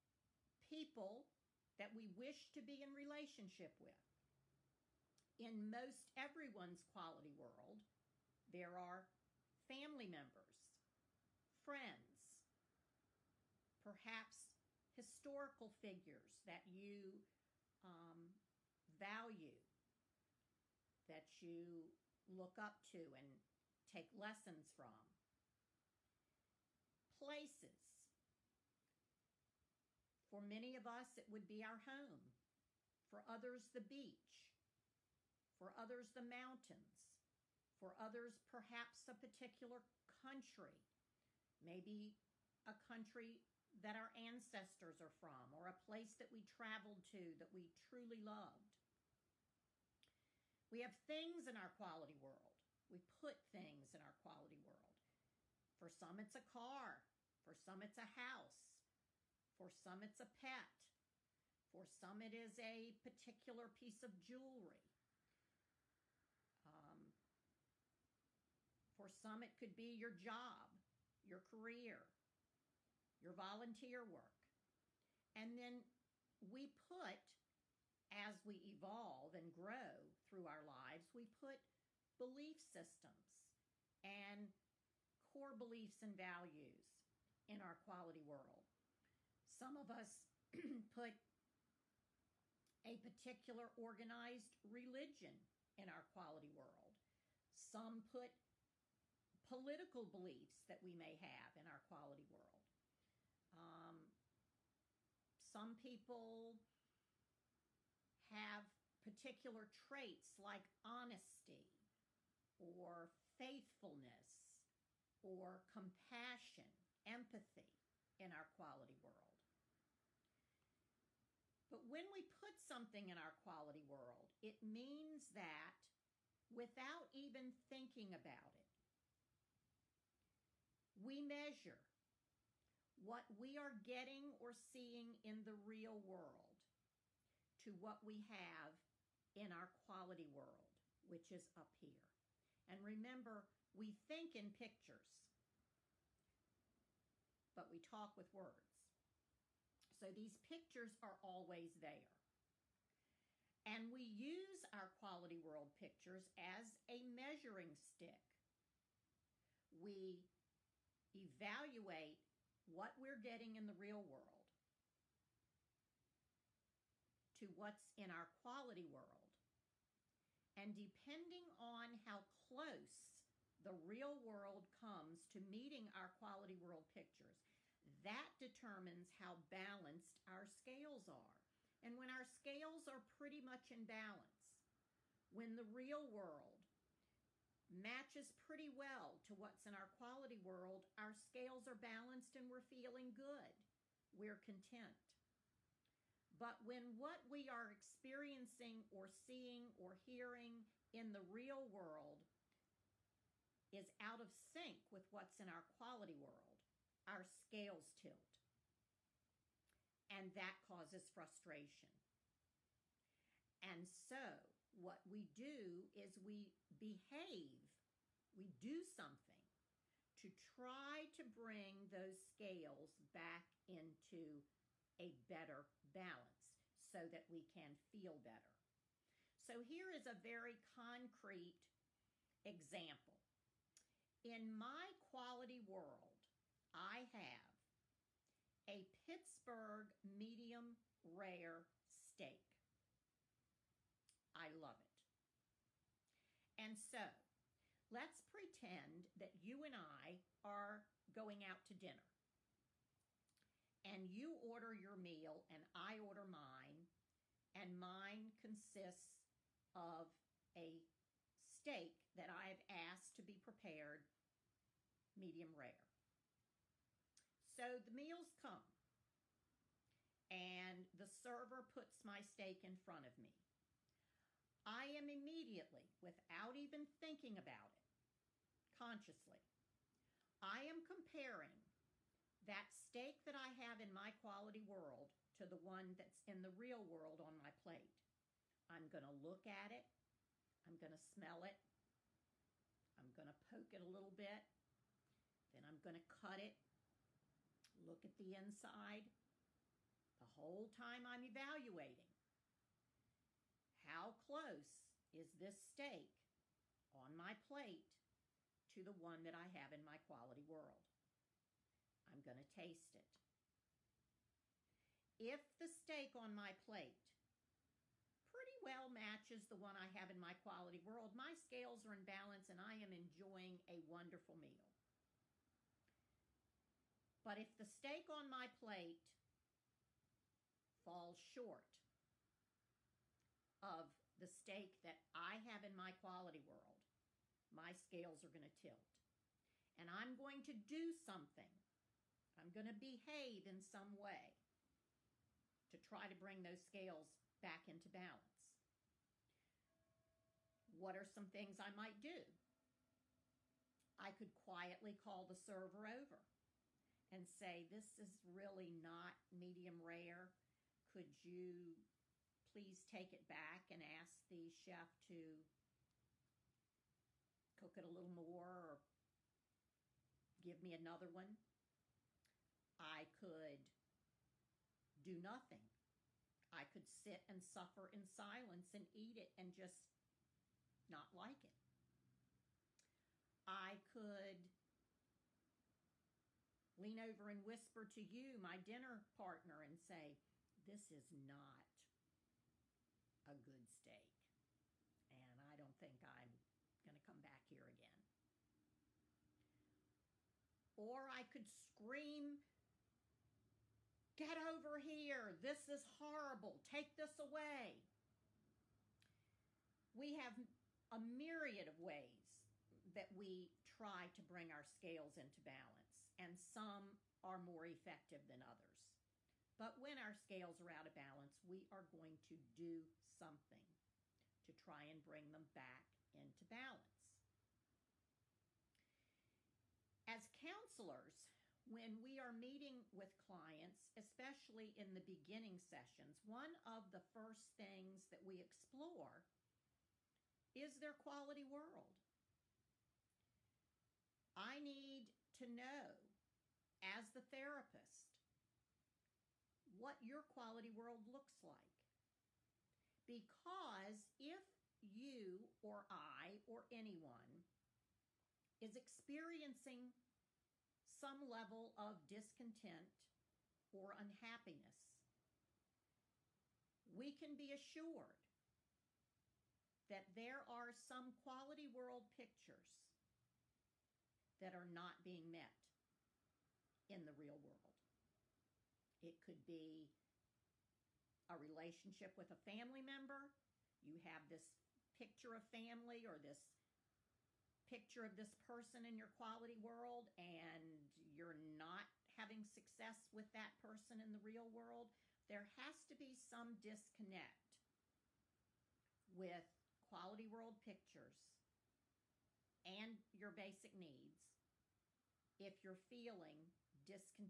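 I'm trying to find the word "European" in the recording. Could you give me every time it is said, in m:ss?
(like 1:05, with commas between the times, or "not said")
not said.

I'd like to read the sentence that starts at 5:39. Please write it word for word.
And I'm going to do something.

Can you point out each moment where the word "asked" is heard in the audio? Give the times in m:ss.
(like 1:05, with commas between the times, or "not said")
4:22.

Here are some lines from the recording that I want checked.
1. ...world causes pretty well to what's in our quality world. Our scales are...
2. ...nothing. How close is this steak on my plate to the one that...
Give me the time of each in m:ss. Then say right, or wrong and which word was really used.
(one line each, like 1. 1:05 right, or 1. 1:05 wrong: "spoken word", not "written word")
1. 3:06 wrong: "matches", not "causes"
2. 5:01 wrong: "evaluating", not "nothing".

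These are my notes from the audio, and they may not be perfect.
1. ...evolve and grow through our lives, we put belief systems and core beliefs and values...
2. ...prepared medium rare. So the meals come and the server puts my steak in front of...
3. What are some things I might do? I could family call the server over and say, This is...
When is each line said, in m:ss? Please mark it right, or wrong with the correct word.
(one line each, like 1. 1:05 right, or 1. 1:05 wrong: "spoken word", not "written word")
1. 1:18 right
2. 4:23 right
3. 5:50 wrong: "quietly", not "family".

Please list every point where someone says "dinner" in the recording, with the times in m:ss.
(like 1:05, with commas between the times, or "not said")
4:11, 6:28.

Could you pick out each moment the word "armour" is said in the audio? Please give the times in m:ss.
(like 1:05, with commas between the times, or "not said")
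not said.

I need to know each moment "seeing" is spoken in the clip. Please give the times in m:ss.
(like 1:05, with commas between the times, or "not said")
2:14, 3:19.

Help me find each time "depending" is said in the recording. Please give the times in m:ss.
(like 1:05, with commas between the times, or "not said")
2:50.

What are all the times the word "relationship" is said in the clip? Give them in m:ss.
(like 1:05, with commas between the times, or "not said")
0:02, 8:01.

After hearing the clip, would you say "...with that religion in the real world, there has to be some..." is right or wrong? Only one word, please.
wrong.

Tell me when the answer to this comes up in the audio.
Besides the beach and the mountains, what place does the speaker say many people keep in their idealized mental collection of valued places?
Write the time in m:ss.
0:31.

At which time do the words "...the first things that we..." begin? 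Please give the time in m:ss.
7:16.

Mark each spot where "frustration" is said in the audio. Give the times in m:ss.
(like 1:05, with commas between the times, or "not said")
3:31.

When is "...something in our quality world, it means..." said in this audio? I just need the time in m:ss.
2:02.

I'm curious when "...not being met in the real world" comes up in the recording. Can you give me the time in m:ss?
7:54.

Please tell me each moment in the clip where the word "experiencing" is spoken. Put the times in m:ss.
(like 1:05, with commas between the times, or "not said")
3:17, 7:38.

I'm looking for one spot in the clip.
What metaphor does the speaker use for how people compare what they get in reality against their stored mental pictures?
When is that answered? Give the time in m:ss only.
2:37.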